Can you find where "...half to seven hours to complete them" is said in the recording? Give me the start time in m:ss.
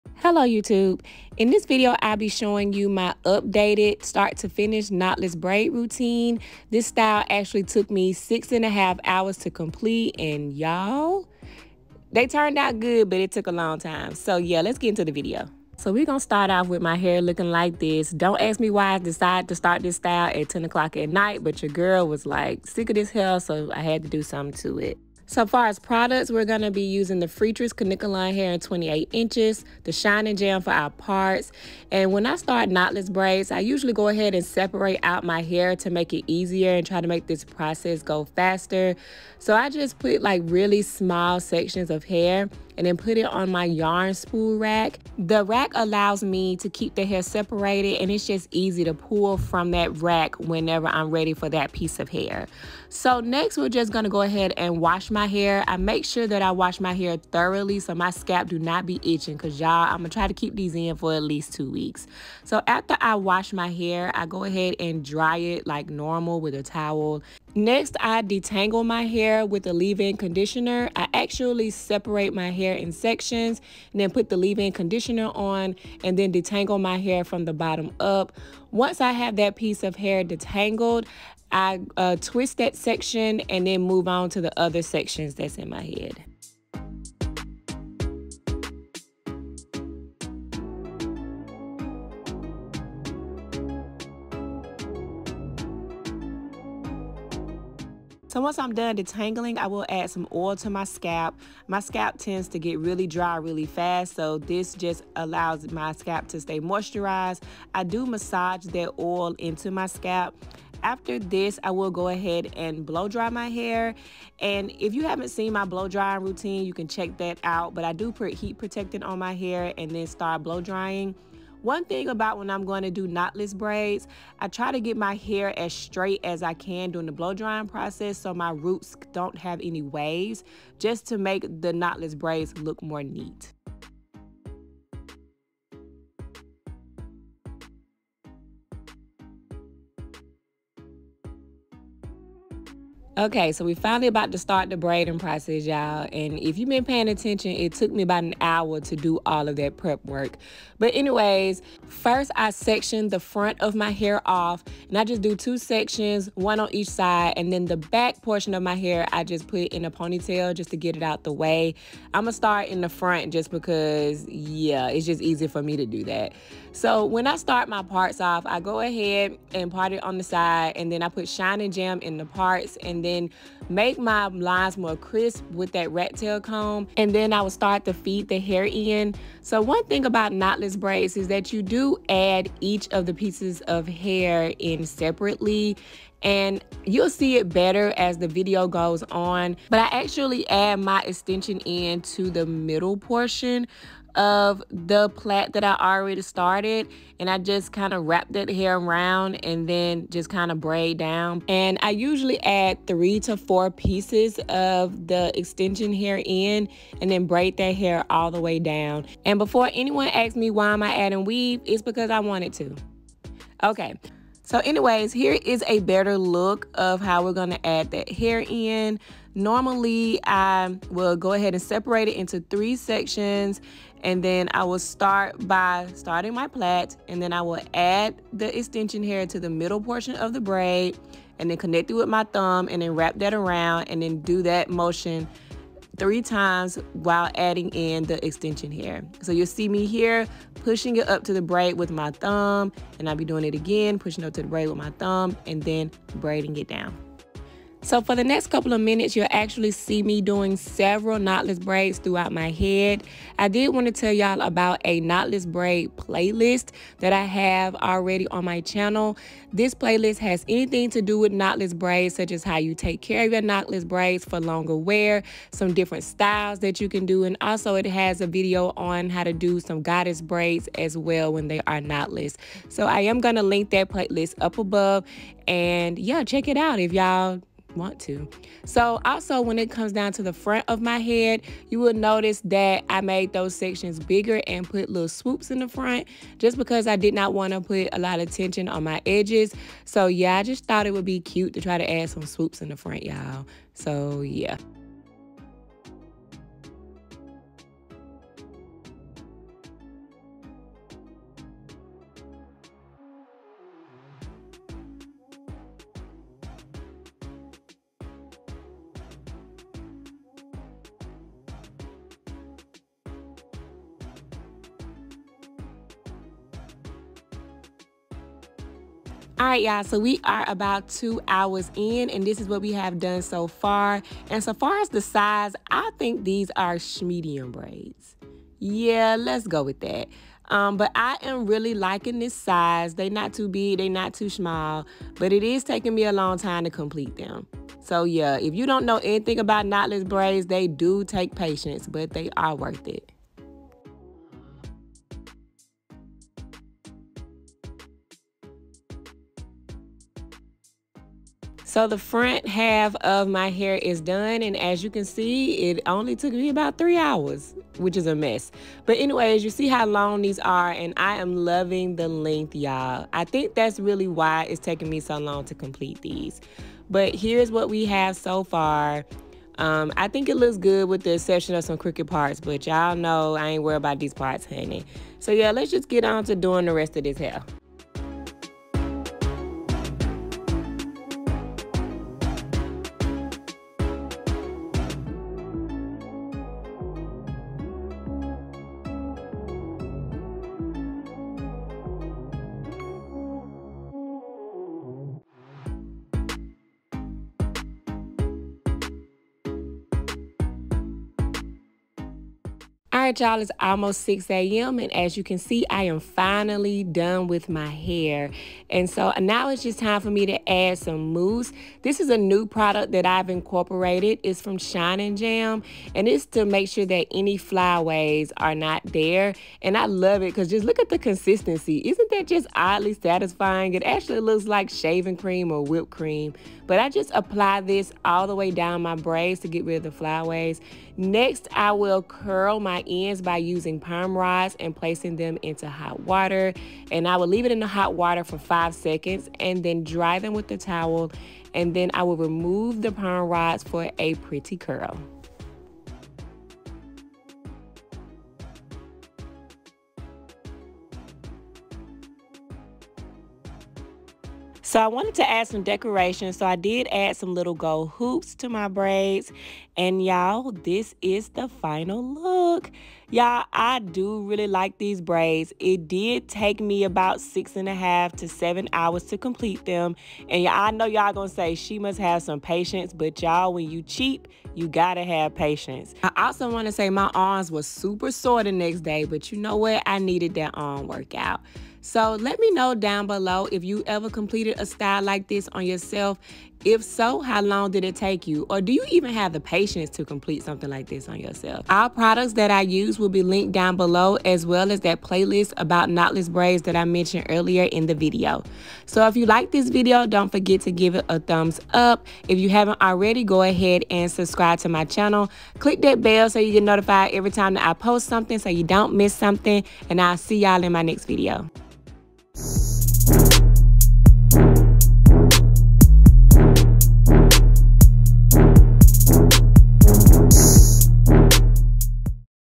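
7:47.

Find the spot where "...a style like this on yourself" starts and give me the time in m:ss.
8:04.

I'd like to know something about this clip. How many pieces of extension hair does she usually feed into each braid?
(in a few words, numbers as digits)
3 to 4.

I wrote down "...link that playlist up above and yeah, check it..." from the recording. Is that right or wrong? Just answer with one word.
right.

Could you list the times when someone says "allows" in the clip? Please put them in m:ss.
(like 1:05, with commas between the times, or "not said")
0:45, 1:45.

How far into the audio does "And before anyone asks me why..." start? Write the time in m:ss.
3:29.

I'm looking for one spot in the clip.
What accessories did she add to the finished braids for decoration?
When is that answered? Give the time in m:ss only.
7:37.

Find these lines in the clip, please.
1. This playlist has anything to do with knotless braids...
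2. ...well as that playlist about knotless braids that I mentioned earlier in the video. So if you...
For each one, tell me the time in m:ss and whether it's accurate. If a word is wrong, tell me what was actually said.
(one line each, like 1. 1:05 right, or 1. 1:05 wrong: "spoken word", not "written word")
1. 4:19 right
2. 8:14 right.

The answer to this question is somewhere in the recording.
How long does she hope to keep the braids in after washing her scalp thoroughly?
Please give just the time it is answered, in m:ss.
1:01.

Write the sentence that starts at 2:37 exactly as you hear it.
And then the back portion of my hair, I just put in a ponytail just to get it out the way.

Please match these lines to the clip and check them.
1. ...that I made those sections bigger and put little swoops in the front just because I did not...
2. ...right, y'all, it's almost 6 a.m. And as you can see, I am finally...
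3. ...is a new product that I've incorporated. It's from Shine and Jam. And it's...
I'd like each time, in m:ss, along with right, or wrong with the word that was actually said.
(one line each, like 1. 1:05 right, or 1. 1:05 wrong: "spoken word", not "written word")
1. 4:42 right
2. 6:43 right
3. 6:51 right.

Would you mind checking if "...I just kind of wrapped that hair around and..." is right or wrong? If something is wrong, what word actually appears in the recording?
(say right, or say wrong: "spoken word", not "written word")
right.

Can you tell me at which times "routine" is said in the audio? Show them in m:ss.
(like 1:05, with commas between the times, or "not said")
0:05, 1:56.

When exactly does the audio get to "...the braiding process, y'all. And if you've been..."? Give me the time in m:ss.
2:24.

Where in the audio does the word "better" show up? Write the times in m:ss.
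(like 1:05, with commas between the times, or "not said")
3:07, 3:35.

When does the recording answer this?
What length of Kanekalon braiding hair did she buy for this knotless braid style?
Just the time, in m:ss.
0:28.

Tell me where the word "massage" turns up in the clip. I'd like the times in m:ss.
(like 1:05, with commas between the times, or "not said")
1:48.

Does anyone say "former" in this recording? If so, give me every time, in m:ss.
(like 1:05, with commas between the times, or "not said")
not said.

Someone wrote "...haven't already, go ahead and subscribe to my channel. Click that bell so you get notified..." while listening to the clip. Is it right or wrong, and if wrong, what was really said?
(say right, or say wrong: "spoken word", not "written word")
right.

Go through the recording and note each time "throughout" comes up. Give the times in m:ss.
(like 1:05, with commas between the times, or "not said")
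4:11.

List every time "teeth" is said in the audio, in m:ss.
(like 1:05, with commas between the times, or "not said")
not said.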